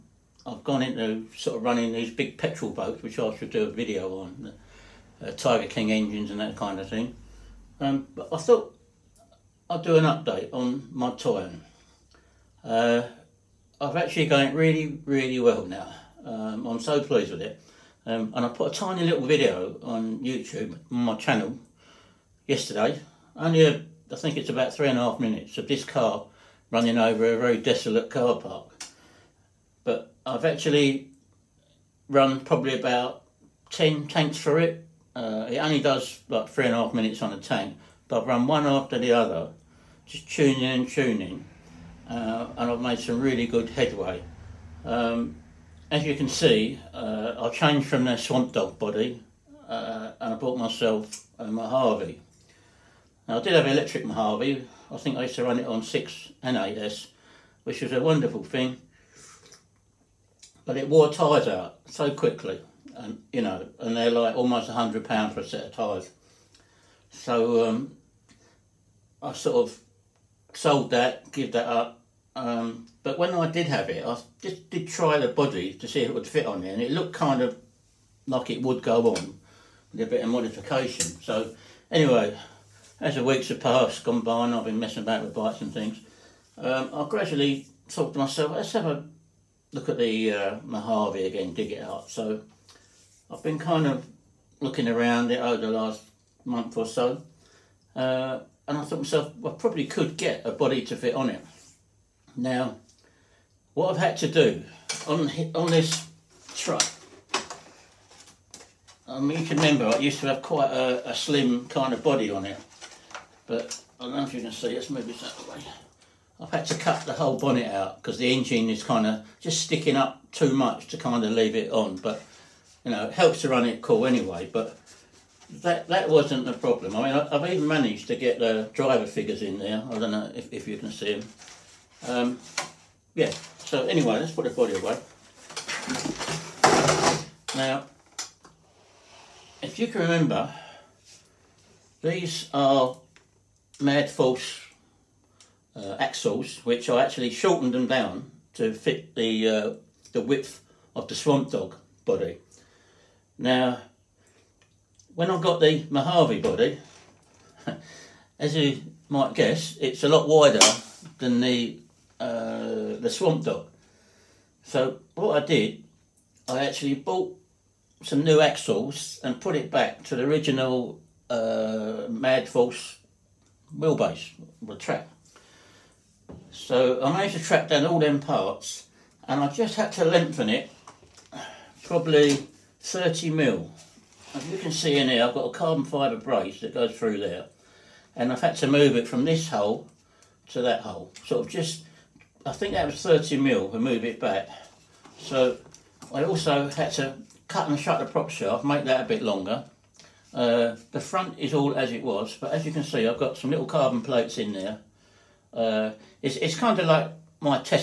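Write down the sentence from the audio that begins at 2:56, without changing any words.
So I managed to track down all them parts and I just had to lengthen it probably 30 mil.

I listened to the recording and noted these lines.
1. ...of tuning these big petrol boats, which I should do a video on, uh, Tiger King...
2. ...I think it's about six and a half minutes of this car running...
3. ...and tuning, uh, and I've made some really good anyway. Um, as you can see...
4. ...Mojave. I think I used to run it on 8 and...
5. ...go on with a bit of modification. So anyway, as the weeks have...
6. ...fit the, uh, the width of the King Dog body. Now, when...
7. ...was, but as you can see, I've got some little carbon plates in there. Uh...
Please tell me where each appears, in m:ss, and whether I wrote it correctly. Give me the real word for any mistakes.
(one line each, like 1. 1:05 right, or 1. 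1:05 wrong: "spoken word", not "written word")
1. 0:01 wrong: "running", not "tuning"
2. 0:24 wrong: "three", not "six"
3. 0:40 wrong: "headway", not "anyway"
4. 0:54 wrong: "6", not "8"
5. 1:18 right
6. 2:28 wrong: "Swamp", not "King"
7. 3:22 right.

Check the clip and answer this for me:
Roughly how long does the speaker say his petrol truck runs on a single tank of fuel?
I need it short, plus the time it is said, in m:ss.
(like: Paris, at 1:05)
3.5 minutes, at 0:36.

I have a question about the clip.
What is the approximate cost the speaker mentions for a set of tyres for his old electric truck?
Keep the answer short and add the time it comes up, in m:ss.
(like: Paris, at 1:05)
almost £100, at 1:04.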